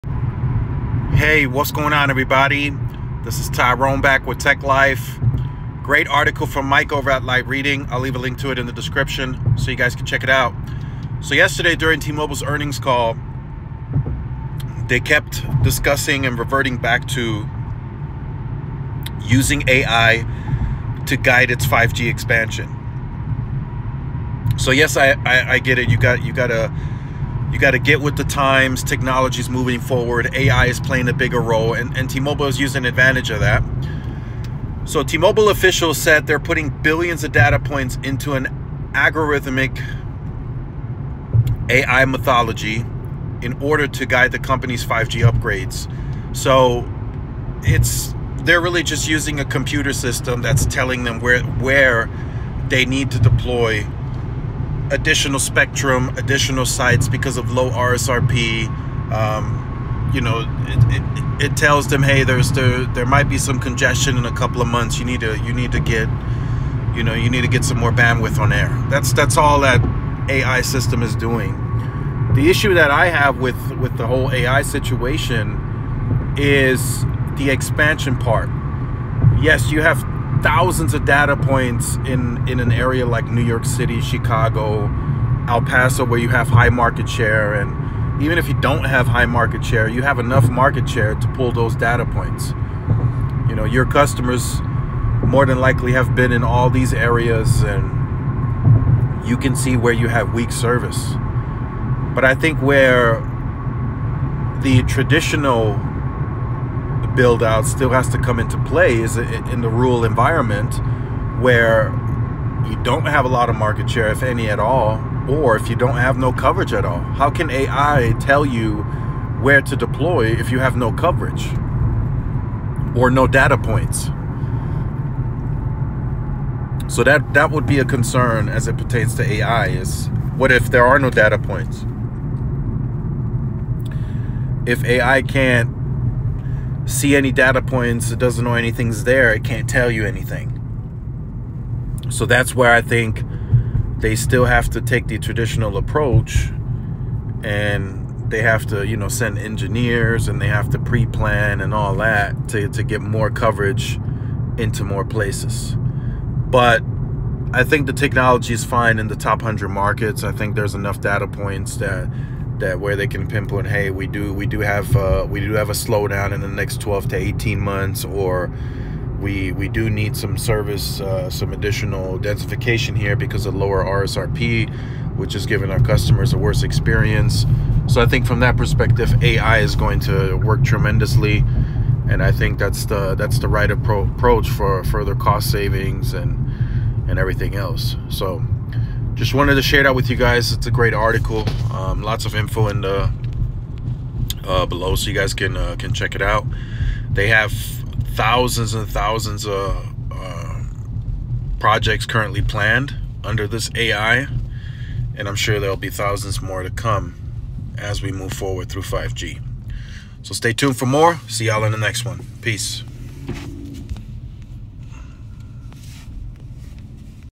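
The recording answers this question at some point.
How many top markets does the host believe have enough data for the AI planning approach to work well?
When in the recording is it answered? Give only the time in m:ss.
2:39.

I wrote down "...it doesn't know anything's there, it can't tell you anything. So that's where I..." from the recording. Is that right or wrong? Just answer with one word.
right.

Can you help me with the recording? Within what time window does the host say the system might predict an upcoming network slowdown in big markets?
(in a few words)
12 to 18 months.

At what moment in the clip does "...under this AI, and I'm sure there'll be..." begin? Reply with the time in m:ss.
3:23.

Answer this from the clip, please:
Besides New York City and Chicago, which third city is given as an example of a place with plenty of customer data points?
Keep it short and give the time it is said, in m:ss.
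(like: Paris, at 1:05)
El Paso, at 1:25.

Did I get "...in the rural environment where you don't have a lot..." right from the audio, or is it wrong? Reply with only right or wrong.
right.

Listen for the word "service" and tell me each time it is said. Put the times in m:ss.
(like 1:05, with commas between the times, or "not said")
1:40, 2:50.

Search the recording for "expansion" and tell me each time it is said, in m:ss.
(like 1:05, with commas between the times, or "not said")
0:22, 1:17.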